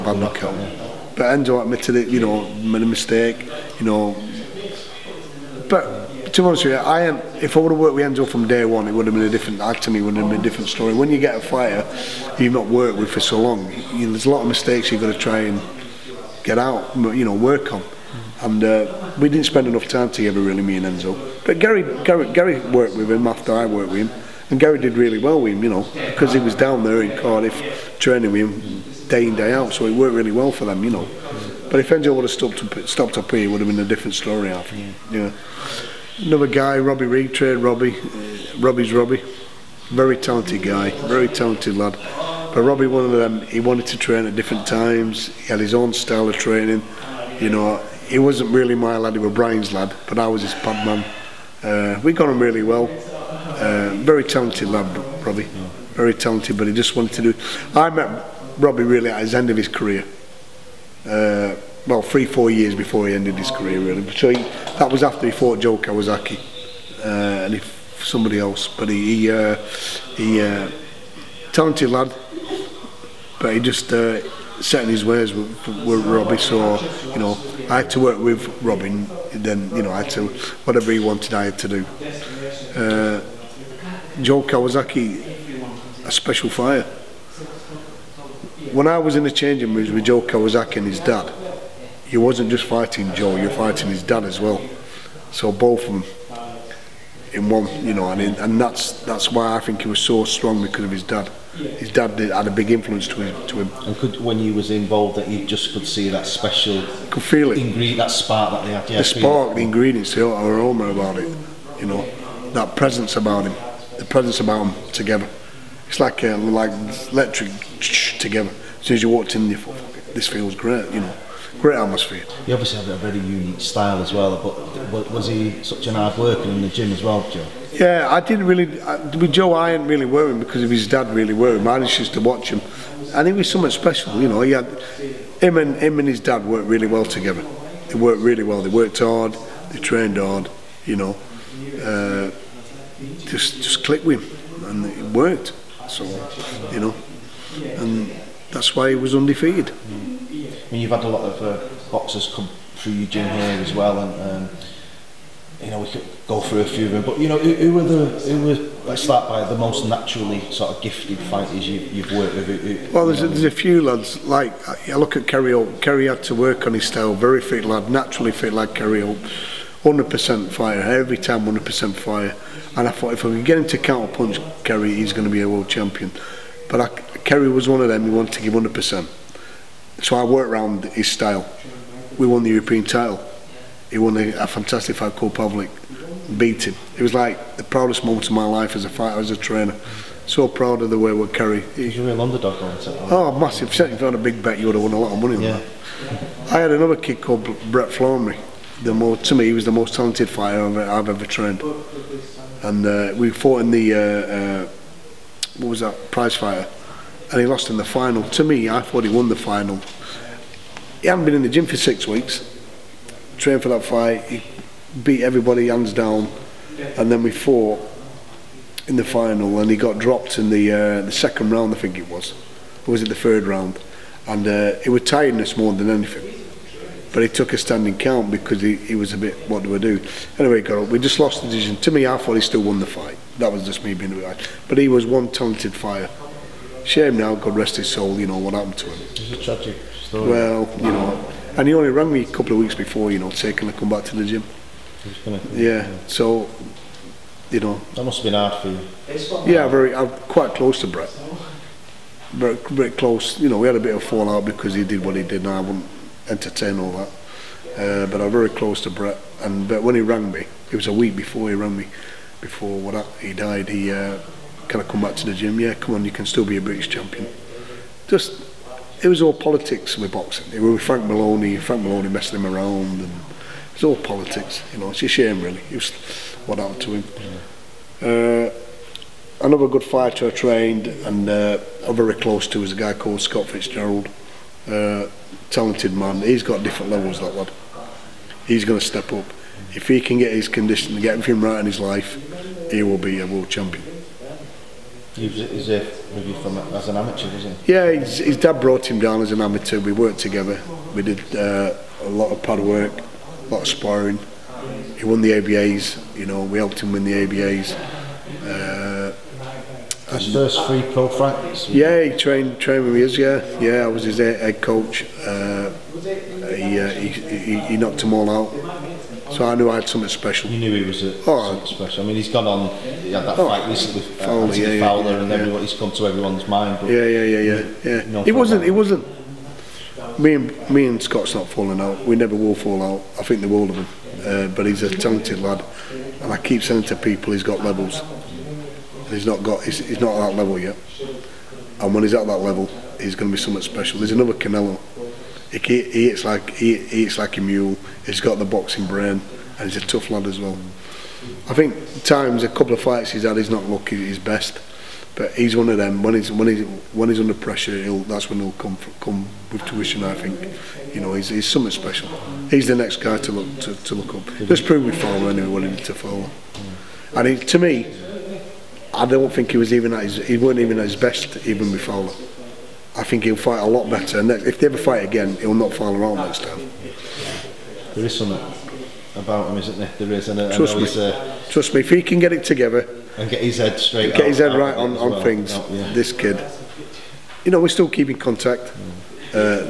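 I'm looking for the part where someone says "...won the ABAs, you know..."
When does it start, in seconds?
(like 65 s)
305 s.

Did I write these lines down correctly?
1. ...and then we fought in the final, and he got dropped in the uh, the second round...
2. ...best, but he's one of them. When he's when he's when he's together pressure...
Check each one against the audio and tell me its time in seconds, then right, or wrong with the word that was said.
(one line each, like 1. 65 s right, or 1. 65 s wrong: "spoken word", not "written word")
1. 216 s right
2. 354 s wrong: "under", not "together".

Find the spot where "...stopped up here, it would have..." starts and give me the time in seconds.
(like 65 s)
32 s.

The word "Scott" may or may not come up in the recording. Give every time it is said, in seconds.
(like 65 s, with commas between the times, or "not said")
283 s, 331 s.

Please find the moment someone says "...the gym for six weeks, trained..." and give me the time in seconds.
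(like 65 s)
211 s.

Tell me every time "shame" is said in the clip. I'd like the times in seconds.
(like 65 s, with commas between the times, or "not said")
236 s, 275 s.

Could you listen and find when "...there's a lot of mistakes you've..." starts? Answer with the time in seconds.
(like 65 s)
14 s.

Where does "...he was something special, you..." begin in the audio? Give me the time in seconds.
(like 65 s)
133 s.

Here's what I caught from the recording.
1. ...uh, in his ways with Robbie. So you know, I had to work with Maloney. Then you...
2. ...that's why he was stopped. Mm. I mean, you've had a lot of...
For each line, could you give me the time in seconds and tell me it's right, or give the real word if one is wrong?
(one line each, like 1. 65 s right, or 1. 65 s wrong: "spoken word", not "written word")
1. 73 s wrong: "Robin", not "Maloney"
2. 148 s wrong: "undefeated", not "stopped".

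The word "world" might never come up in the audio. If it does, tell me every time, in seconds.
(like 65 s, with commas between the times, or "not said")
175 s, 293 s, 333 s.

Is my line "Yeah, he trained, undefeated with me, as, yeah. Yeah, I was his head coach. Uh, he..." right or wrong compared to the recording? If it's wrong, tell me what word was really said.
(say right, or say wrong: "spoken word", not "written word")
wrong: "trained", not "undefeated".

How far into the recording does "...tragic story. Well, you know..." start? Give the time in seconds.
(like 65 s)
239 s.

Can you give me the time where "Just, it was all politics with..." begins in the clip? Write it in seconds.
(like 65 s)
268 s.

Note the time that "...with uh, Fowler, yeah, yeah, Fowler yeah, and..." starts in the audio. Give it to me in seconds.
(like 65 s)
324 s.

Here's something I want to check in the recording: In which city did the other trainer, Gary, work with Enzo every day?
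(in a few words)
Cardiff.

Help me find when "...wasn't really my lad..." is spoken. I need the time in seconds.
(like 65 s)
48 s.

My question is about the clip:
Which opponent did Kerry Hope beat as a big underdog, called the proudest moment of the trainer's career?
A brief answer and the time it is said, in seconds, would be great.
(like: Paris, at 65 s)
Pavlik, at 185 s.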